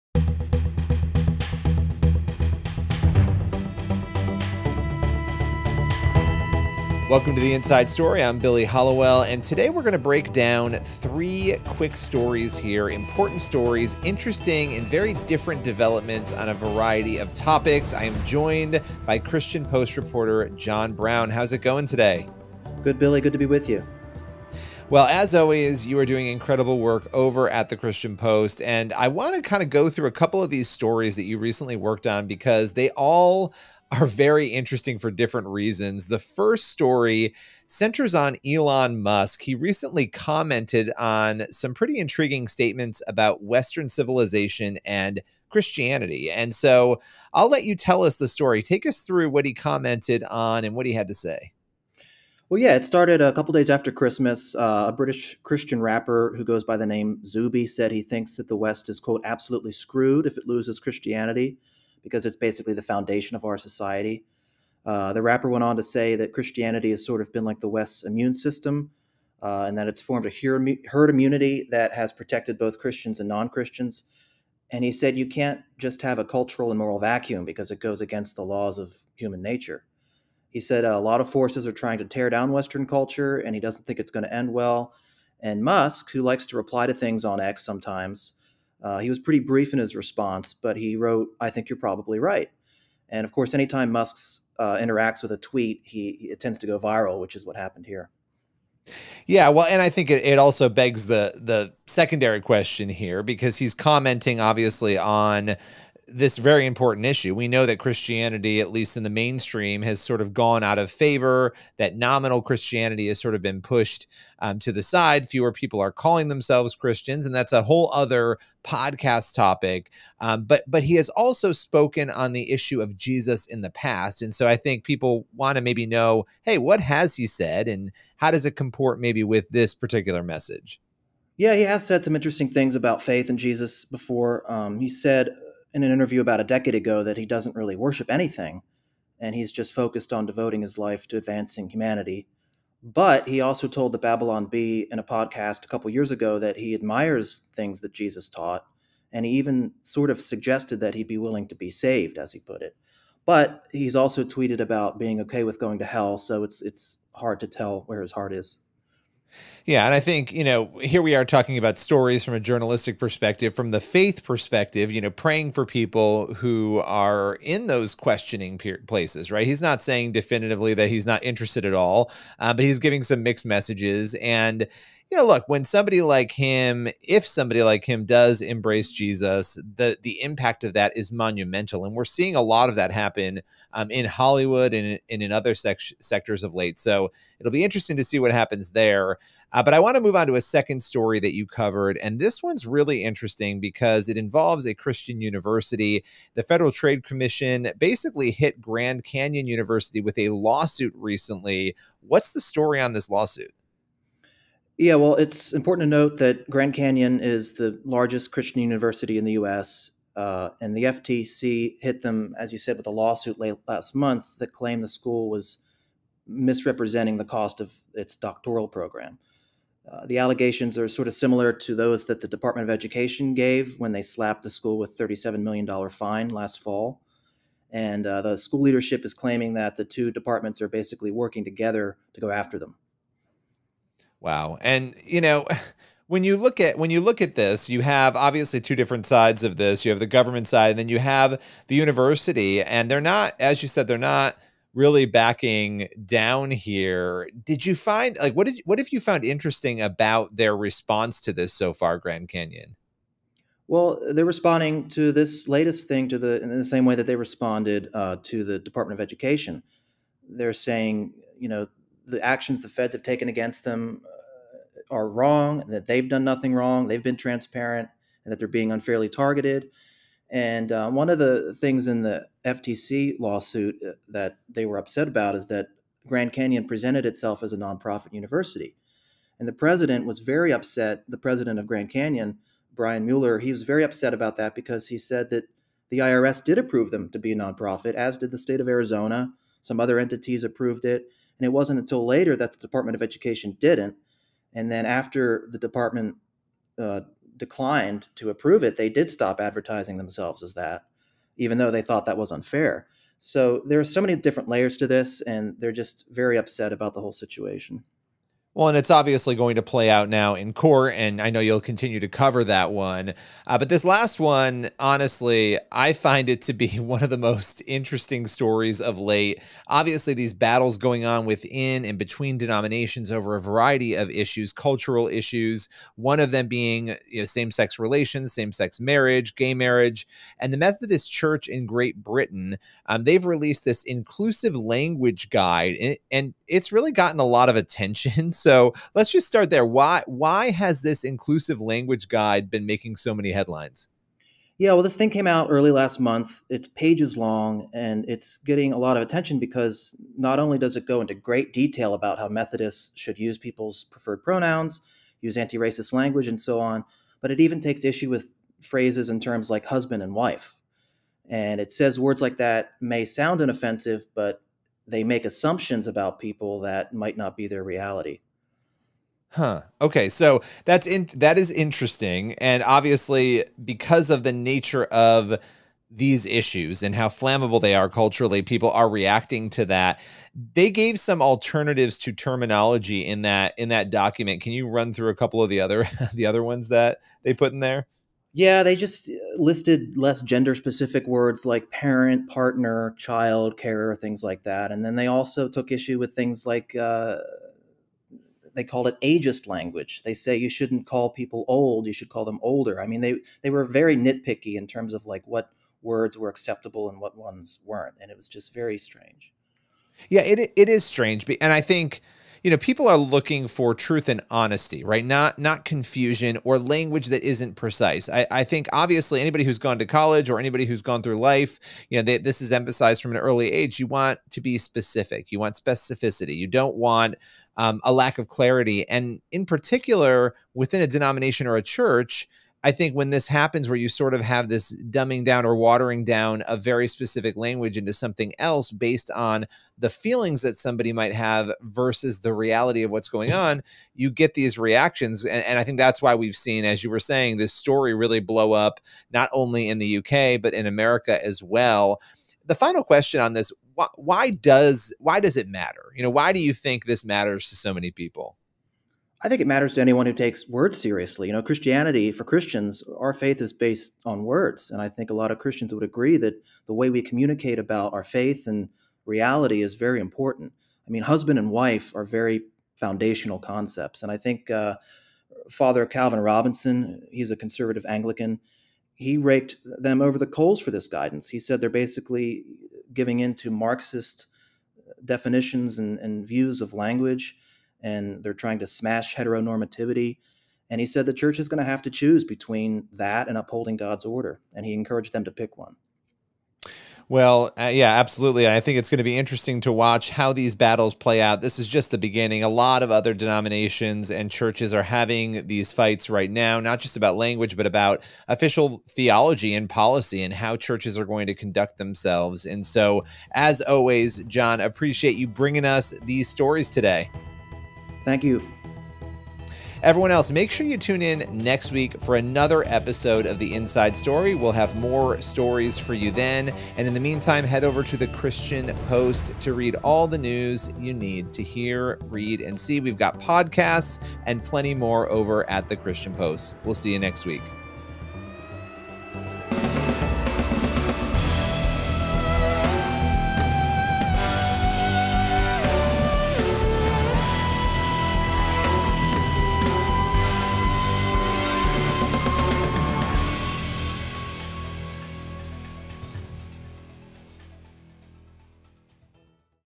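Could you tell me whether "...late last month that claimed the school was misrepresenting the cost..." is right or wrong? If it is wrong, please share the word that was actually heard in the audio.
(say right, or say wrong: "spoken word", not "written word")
right.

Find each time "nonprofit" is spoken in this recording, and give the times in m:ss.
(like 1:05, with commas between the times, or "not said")
4:37, 4:47.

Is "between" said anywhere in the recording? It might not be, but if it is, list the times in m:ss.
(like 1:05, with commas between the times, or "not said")
5:21, 8:12.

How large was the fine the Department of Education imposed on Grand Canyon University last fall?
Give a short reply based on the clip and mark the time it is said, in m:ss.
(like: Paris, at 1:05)
$37 million, at 3:44.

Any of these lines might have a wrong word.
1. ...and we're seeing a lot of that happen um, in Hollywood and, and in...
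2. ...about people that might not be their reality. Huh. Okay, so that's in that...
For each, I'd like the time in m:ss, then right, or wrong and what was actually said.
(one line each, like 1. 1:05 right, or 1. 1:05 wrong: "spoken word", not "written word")
1. 3:01 right
2. 6:05 right.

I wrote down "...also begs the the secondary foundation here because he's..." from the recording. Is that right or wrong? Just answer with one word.
wrong.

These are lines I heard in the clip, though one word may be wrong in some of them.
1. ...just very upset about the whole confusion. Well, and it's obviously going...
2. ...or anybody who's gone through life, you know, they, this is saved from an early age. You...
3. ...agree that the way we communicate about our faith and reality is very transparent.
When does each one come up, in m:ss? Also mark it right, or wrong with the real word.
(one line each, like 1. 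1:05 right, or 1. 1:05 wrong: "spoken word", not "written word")
1. 5:05 wrong: "situation", not "confusion"
2. 7:00 wrong: "emphasized", not "saved"
3. 7:45 wrong: "important", not "transparent".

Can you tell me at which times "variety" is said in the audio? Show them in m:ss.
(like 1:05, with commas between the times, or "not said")
0:16, 5:23.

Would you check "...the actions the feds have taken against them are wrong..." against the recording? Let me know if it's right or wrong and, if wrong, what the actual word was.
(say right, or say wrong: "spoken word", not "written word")
right.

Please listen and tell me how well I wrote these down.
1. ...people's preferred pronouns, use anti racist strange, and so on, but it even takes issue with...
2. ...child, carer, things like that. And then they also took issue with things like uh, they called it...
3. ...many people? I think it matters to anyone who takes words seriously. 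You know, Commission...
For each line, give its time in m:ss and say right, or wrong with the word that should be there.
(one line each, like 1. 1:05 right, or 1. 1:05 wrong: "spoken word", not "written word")
1. 5:53 wrong: "language", not "strange"
2. 6:32 right
3. 7:37 wrong: "Christianity", not "Commission".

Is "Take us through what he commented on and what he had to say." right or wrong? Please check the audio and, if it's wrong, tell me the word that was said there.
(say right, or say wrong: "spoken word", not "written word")
right.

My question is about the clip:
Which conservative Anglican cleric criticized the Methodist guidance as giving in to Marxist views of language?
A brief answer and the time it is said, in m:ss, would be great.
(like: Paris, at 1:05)
Calvin Robinson, at 7:55.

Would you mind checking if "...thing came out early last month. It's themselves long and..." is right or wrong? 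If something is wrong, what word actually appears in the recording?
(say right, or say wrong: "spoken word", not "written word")
wrong: "pages", not "themselves".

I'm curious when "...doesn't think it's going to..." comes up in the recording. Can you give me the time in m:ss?
1:23.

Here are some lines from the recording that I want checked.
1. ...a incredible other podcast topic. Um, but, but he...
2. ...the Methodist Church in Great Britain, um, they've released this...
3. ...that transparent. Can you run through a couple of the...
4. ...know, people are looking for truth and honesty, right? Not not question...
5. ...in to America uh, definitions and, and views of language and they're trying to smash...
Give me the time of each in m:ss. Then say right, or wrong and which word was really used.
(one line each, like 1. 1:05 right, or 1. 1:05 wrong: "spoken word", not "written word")
1. 1:57 wrong: "whole", not "incredible"
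2. 5:30 right
3. 6:23 wrong: "document", not "transparent"
4. 6:52 wrong: "confusion", not "question"
5. 8:03 wrong: "Marxist", not "America".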